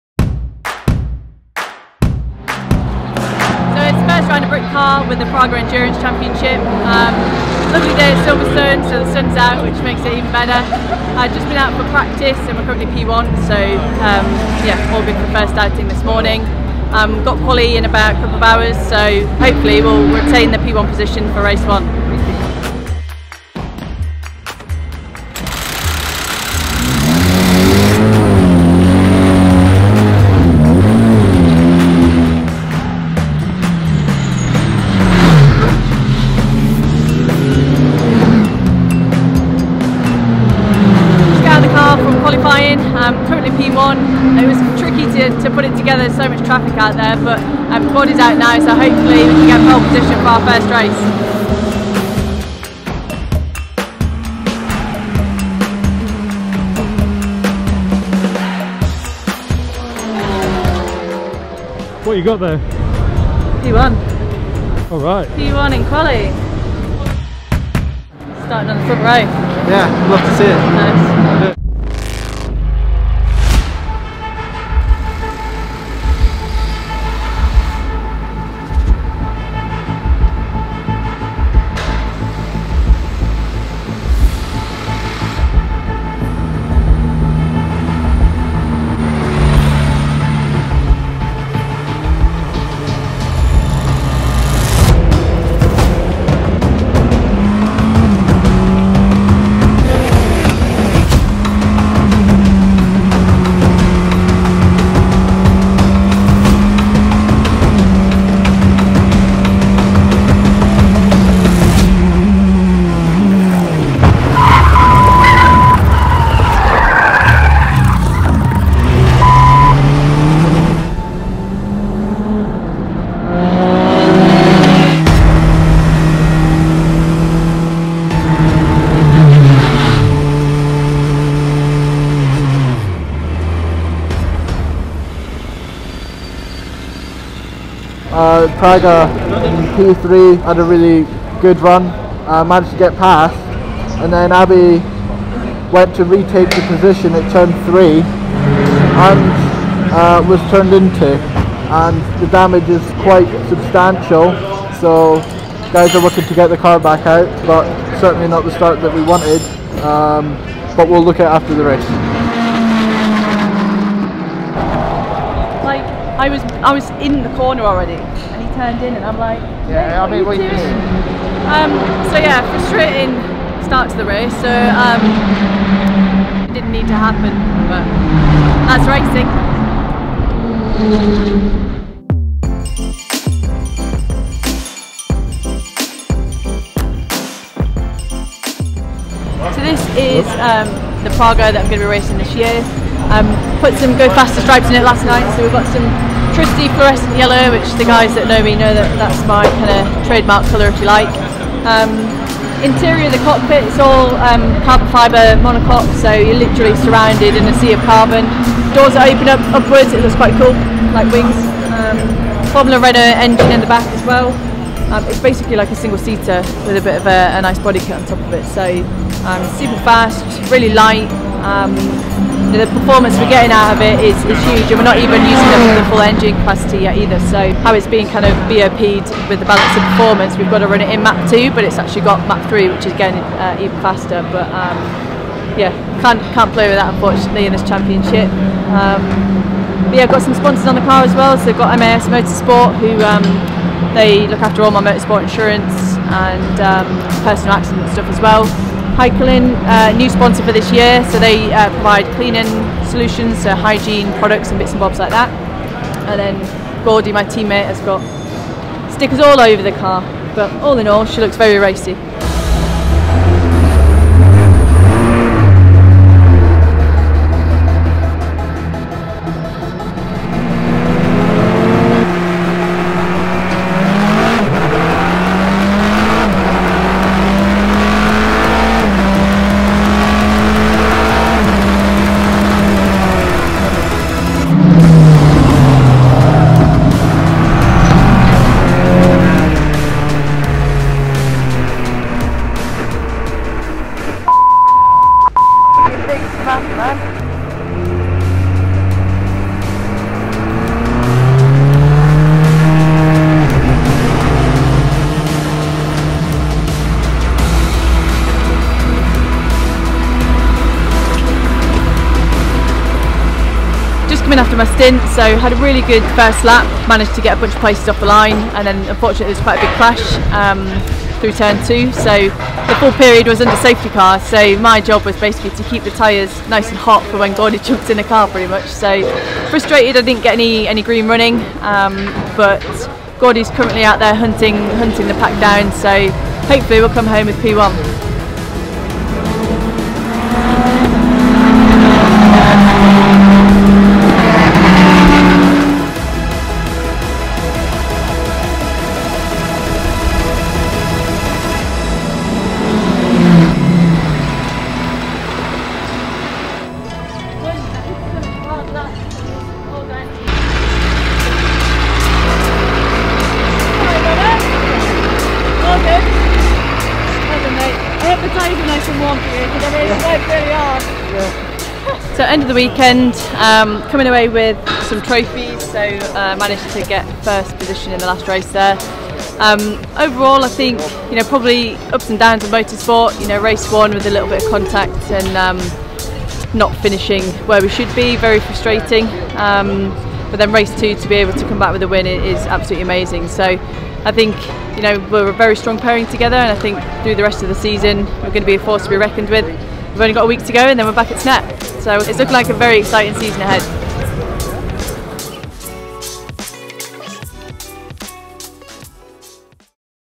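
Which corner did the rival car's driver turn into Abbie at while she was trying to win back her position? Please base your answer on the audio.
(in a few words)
Turn 3.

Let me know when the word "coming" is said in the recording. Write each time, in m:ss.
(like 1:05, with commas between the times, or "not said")
5:14, 6:13.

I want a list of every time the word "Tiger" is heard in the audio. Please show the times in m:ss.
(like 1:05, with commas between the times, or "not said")
2:18.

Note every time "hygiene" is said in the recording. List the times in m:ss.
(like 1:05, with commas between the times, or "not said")
4:13.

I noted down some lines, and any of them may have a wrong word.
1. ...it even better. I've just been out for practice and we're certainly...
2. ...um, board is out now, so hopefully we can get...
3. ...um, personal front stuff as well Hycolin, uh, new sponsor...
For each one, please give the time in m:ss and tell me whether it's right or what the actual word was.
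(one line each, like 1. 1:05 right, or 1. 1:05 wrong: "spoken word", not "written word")
1. 0:10 wrong: "currently", not "certainly"
2. 0:47 right
3. 4:06 wrong: "accident", not "front".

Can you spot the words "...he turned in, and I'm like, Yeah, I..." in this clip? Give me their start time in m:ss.
2:48.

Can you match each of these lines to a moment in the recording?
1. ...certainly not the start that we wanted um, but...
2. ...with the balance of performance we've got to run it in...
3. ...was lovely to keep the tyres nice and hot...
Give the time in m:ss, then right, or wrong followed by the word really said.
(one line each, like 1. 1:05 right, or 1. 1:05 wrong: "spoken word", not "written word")
1. 2:38 right
2. 3:49 right
3. 5:25 wrong: "basically", not "lovely".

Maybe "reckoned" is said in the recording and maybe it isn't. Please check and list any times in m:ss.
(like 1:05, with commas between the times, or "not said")
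6:38.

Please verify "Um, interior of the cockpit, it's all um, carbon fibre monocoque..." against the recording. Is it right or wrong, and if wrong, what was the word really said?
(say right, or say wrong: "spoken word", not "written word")
right.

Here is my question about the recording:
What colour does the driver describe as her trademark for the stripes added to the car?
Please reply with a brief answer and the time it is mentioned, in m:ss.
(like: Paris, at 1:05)
Fluorescent yellow, at 3:16.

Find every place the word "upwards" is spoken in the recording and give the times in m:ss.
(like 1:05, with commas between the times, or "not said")
3:29.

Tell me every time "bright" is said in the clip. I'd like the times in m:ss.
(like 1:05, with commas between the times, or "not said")
not said.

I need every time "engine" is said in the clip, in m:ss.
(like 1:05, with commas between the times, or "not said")
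3:33, 3:46.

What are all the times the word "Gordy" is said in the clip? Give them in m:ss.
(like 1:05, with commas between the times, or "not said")
4:16, 5:27, 5:33.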